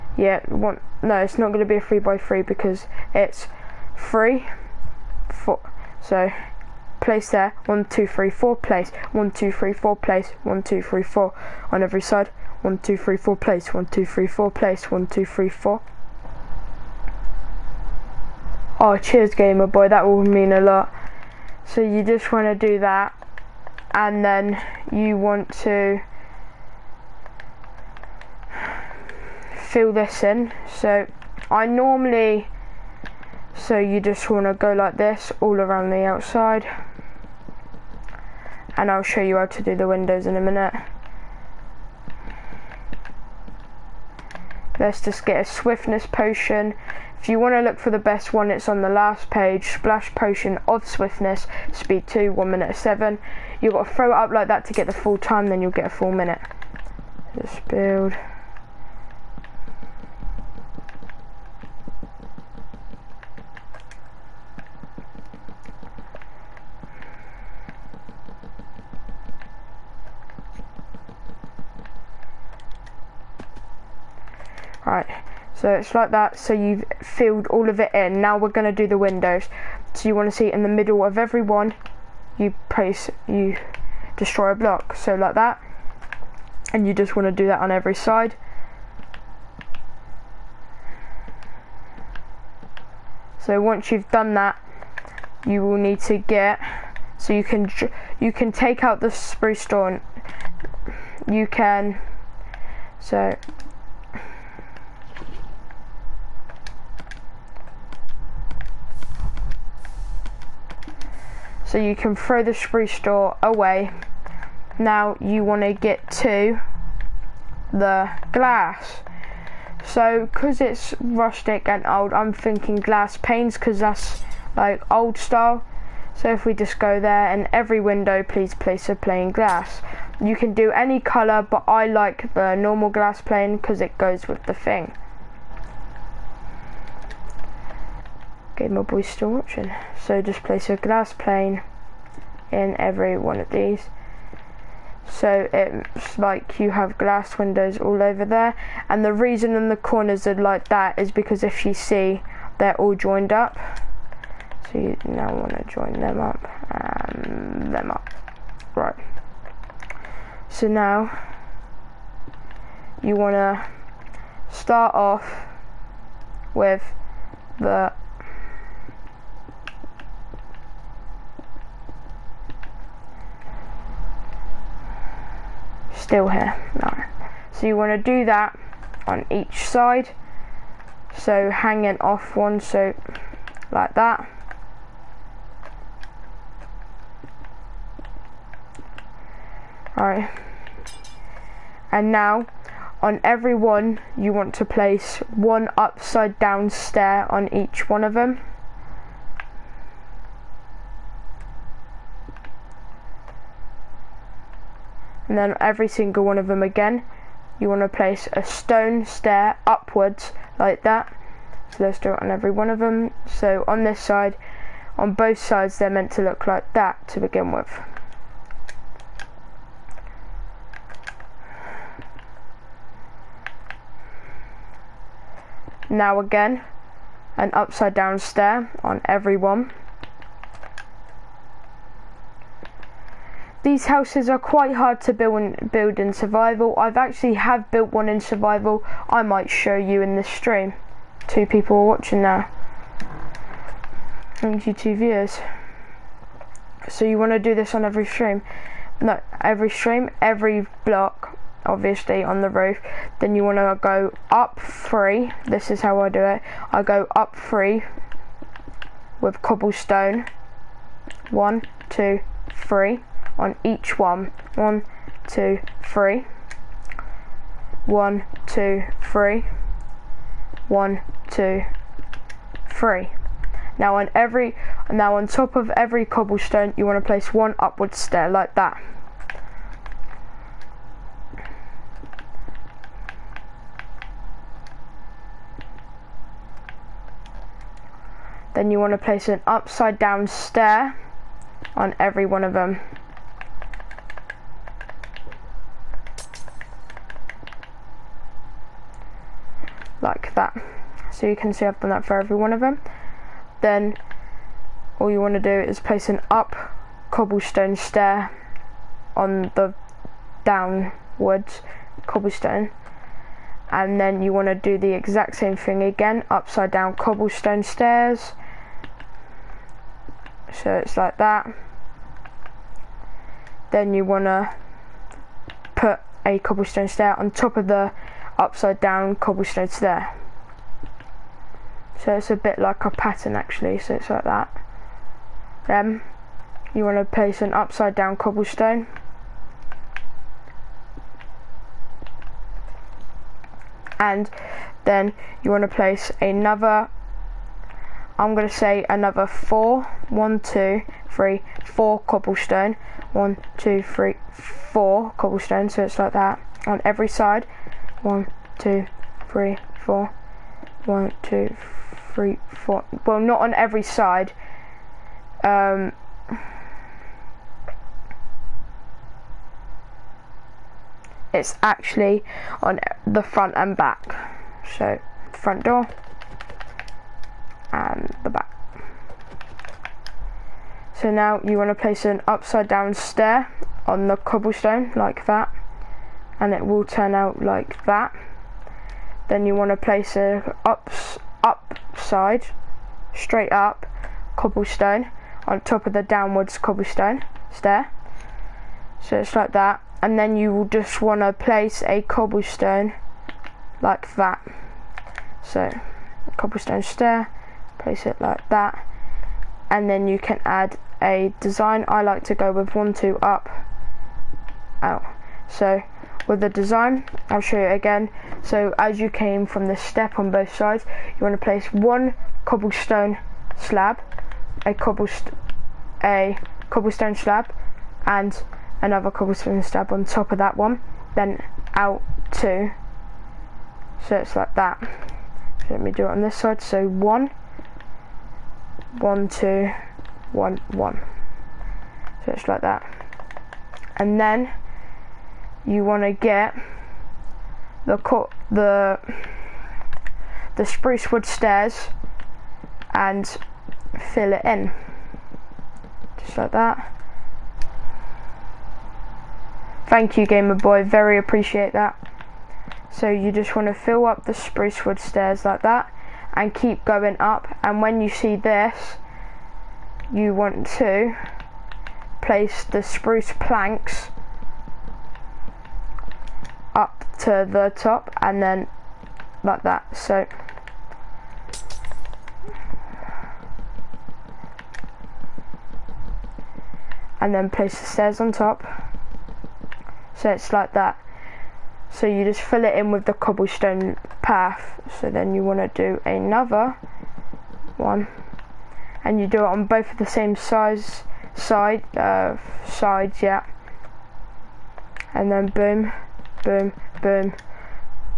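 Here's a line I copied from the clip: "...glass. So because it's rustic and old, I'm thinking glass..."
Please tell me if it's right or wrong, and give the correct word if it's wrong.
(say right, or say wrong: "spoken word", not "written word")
right.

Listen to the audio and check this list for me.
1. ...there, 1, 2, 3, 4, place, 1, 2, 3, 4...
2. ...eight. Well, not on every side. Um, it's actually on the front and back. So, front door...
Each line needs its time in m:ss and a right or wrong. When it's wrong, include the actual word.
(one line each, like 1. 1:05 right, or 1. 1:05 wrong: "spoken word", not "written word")
1. 0:07 right
2. 6:02 wrong: "four", not "eight".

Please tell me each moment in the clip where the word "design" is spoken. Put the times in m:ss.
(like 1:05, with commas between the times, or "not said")
6:51, 6:56.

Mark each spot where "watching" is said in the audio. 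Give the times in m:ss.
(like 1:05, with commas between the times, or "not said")
2:19, 4:01.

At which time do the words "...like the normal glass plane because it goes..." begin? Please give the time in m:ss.
2:11.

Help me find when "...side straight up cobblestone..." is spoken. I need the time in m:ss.
6:31.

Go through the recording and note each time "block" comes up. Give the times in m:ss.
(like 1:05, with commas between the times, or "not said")
1:24, 4:10.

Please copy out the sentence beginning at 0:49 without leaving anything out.
Splash Potion of Swiftness, speed 2, 1 minute 7.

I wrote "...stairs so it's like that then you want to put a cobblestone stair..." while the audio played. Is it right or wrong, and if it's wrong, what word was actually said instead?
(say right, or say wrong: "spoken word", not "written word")
right.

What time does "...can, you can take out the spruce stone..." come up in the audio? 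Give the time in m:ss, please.
1:37.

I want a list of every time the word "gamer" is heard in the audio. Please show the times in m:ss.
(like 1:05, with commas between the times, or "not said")
0:19, 7:40.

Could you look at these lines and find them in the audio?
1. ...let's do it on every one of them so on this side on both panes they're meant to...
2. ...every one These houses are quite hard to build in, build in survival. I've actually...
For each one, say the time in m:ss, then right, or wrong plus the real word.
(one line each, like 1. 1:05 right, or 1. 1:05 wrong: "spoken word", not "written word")
1. 3:31 wrong: "sides", not "panes"
2. 3:49 right.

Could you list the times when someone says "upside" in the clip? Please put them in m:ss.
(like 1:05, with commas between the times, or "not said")
3:15, 3:47, 4:49, 5:16, 5:28, 5:37, 6:22.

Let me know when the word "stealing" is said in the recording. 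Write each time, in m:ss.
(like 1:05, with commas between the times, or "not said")
not said.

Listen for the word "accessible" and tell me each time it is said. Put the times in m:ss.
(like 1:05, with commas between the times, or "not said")
not said.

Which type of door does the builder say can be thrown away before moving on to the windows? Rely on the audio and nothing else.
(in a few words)
spruce door.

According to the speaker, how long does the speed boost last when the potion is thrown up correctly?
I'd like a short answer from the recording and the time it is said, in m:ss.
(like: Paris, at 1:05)
1 minute, at 0:55.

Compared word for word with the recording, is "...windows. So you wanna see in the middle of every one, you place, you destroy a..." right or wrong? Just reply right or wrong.
right.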